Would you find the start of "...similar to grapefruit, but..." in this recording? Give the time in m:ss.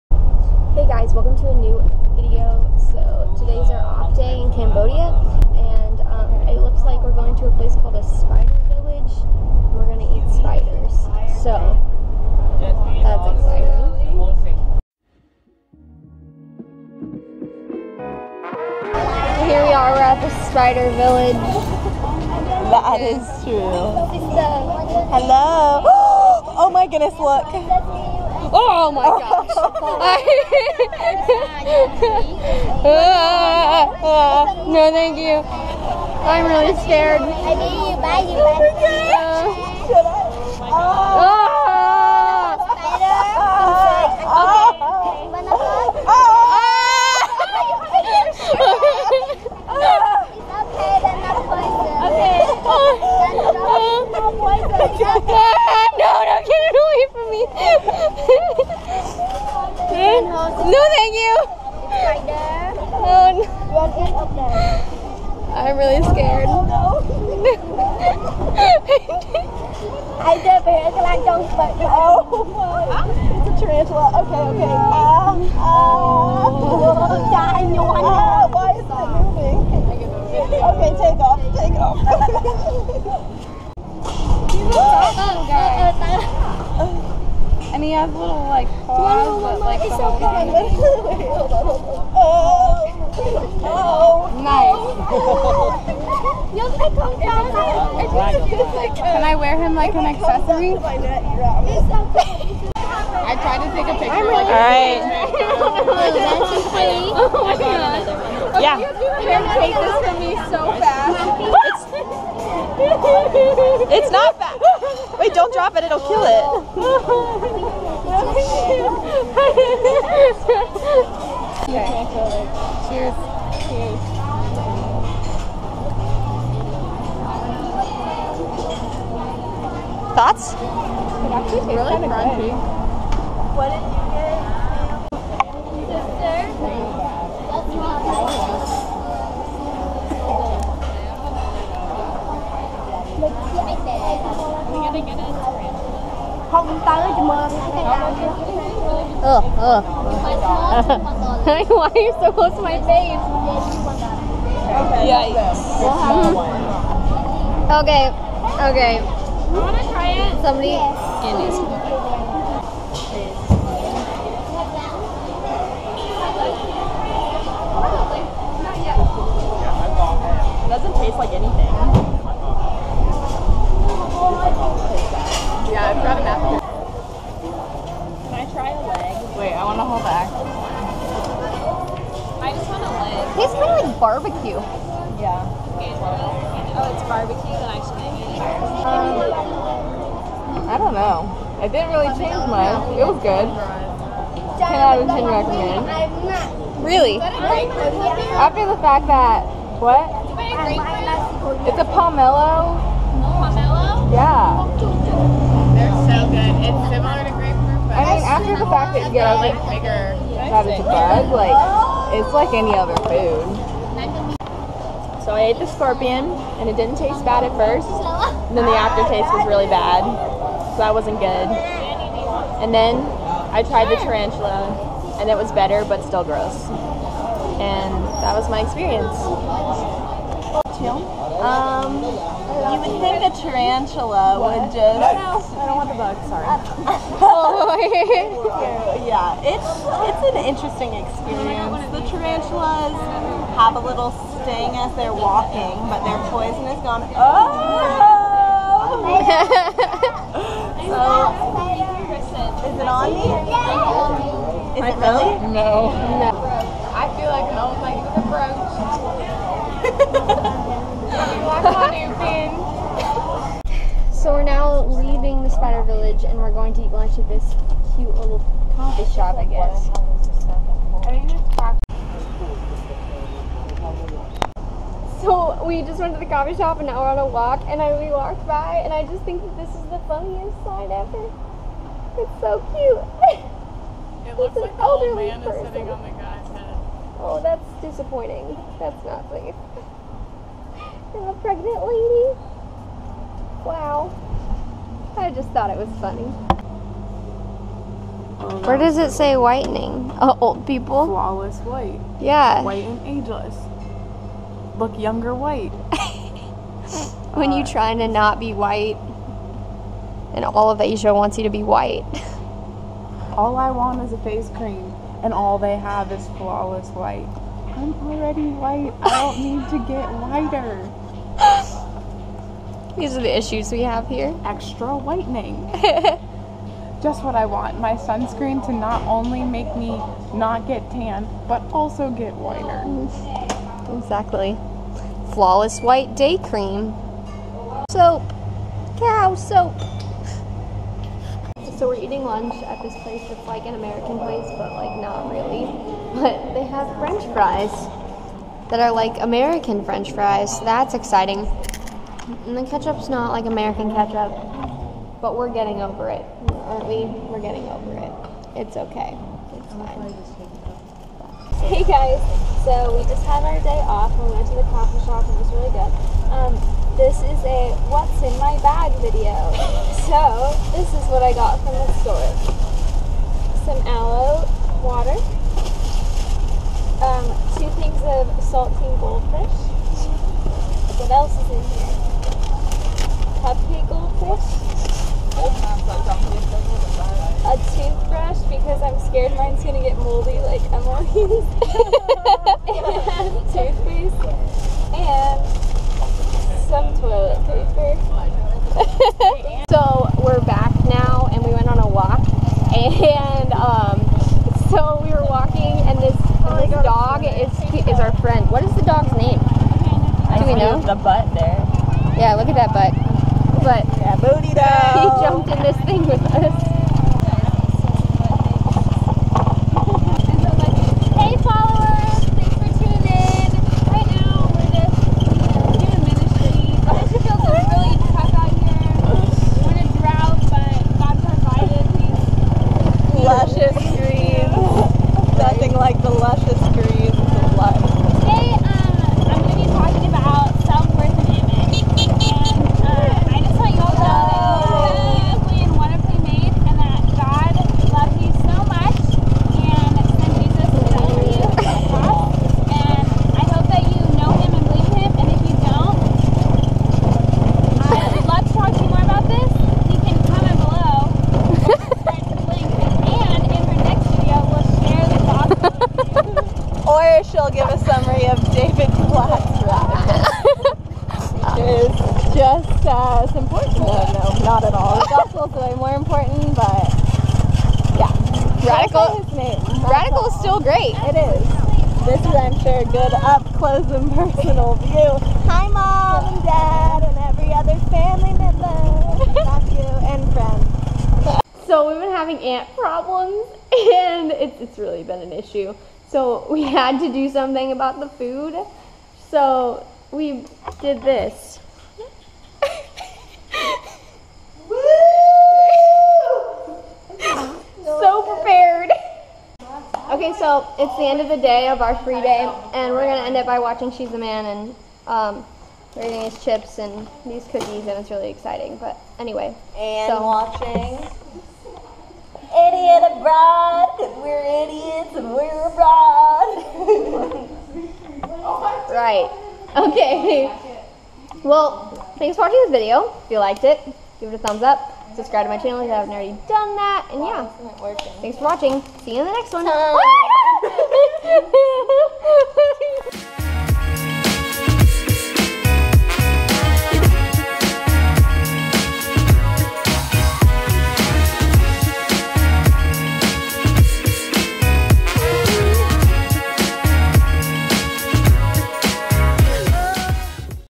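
3:26.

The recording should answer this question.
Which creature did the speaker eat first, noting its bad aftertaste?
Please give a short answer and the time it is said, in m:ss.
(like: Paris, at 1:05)
Scorpion, at 3:35.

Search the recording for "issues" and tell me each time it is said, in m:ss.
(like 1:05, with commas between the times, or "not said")
5:23, 8:15.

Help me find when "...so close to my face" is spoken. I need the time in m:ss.
2:32.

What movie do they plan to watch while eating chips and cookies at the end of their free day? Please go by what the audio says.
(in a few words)
She's a Man.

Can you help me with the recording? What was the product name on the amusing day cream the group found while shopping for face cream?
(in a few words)
Flawless White Day Cream.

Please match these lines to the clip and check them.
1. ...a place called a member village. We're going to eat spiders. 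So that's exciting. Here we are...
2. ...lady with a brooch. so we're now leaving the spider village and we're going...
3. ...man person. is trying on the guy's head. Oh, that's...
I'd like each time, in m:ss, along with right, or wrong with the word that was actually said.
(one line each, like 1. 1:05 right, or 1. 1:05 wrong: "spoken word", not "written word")
1. 0:07 wrong: "spider", not "member"
2. 4:17 right
3. 4:45 wrong: "sitting", not "trying".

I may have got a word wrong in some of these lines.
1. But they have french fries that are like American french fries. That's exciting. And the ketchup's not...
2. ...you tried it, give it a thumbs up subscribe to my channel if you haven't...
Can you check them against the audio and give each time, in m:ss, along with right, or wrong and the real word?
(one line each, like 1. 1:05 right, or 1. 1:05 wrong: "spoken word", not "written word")
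1. 5:46 right
2. 8:53 wrong: "liked", not "tried".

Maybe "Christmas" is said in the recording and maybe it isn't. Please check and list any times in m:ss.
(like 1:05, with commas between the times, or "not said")
not said.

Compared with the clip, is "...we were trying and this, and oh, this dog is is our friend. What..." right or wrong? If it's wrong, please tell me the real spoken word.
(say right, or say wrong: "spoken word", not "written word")
wrong: "walking", not "trying".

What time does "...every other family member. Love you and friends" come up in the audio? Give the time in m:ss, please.
8:07.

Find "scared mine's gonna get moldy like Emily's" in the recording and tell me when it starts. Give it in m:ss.
6:29.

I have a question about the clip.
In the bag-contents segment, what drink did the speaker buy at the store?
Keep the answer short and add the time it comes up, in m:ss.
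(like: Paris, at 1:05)
Aloe water, at 6:13.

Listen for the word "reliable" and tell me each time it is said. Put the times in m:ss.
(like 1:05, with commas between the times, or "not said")
not said.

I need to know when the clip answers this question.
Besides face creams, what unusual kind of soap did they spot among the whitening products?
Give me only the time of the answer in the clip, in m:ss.
5:38.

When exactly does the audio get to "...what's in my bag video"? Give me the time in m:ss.
6:07.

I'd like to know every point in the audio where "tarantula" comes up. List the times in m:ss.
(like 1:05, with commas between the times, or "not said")
1:13, 3:44, 3:53, 4:02.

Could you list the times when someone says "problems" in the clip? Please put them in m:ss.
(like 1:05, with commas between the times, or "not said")
8:12.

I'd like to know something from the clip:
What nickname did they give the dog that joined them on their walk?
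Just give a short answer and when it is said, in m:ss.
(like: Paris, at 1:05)
Booty dog, at 6:54.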